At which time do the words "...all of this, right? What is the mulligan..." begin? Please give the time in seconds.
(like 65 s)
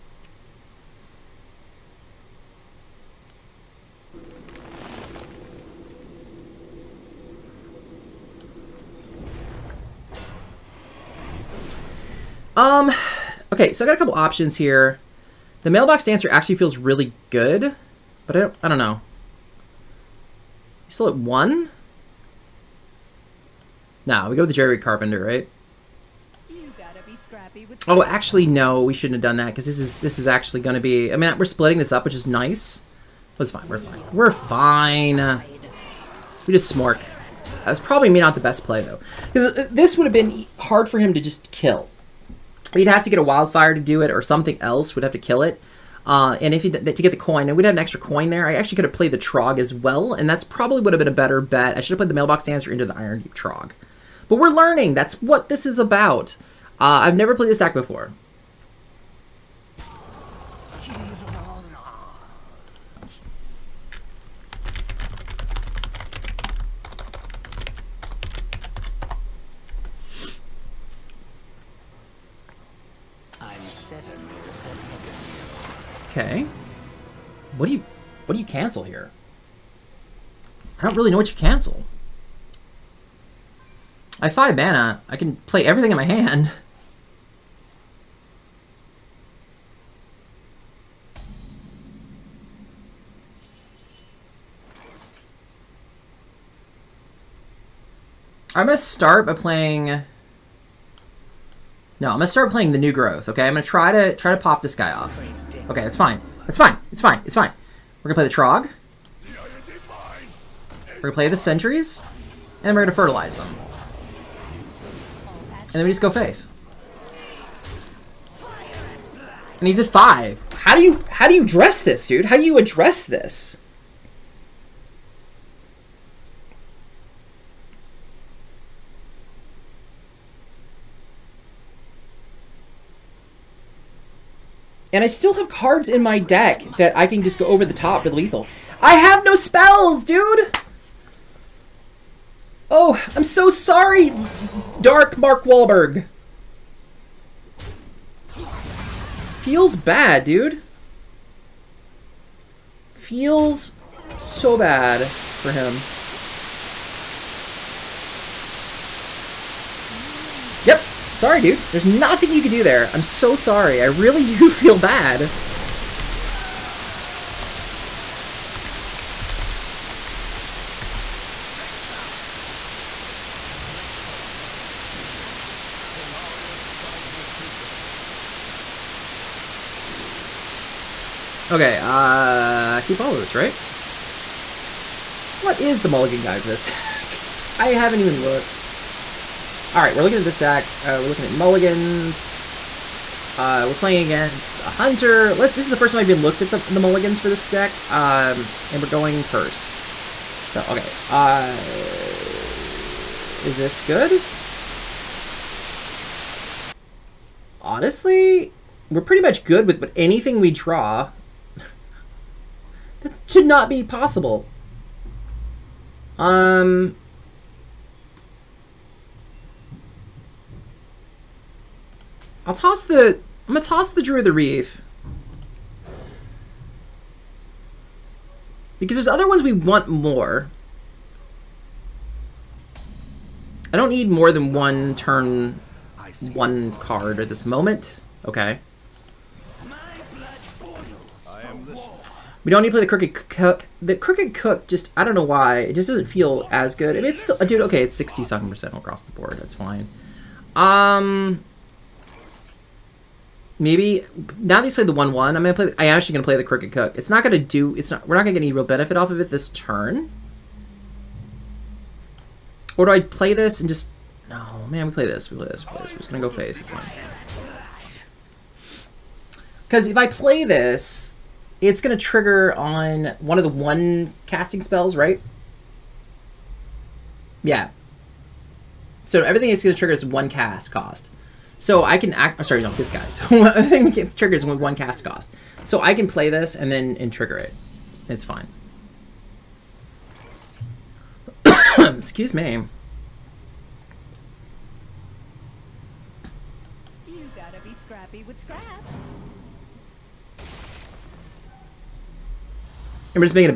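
183 s.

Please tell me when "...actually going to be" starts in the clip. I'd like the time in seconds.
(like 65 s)
30 s.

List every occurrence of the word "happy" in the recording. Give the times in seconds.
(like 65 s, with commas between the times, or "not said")
not said.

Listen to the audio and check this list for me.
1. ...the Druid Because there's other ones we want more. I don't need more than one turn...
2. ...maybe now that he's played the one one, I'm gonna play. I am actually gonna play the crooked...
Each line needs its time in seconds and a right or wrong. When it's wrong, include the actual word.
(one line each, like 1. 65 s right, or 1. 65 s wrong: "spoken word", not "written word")
1. 224 s wrong: "Reef", not "Druid"
2. 253 s right.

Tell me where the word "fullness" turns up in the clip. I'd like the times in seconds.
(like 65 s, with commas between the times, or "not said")
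not said.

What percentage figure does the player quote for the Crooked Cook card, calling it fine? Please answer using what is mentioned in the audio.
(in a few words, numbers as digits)
67%.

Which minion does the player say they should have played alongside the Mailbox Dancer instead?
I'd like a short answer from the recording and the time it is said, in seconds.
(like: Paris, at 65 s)
Iron Deep Trog, at 52 s.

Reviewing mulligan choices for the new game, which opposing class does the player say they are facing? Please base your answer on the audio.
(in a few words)
Hunter.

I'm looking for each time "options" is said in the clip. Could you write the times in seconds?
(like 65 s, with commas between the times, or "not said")
14 s.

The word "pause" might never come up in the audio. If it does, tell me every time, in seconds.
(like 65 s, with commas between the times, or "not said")
not said.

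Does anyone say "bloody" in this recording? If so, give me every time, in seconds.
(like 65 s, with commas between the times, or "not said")
not said.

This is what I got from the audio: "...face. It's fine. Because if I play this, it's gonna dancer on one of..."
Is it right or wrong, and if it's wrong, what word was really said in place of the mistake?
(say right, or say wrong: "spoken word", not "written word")
wrong: "trigger", not "dancer".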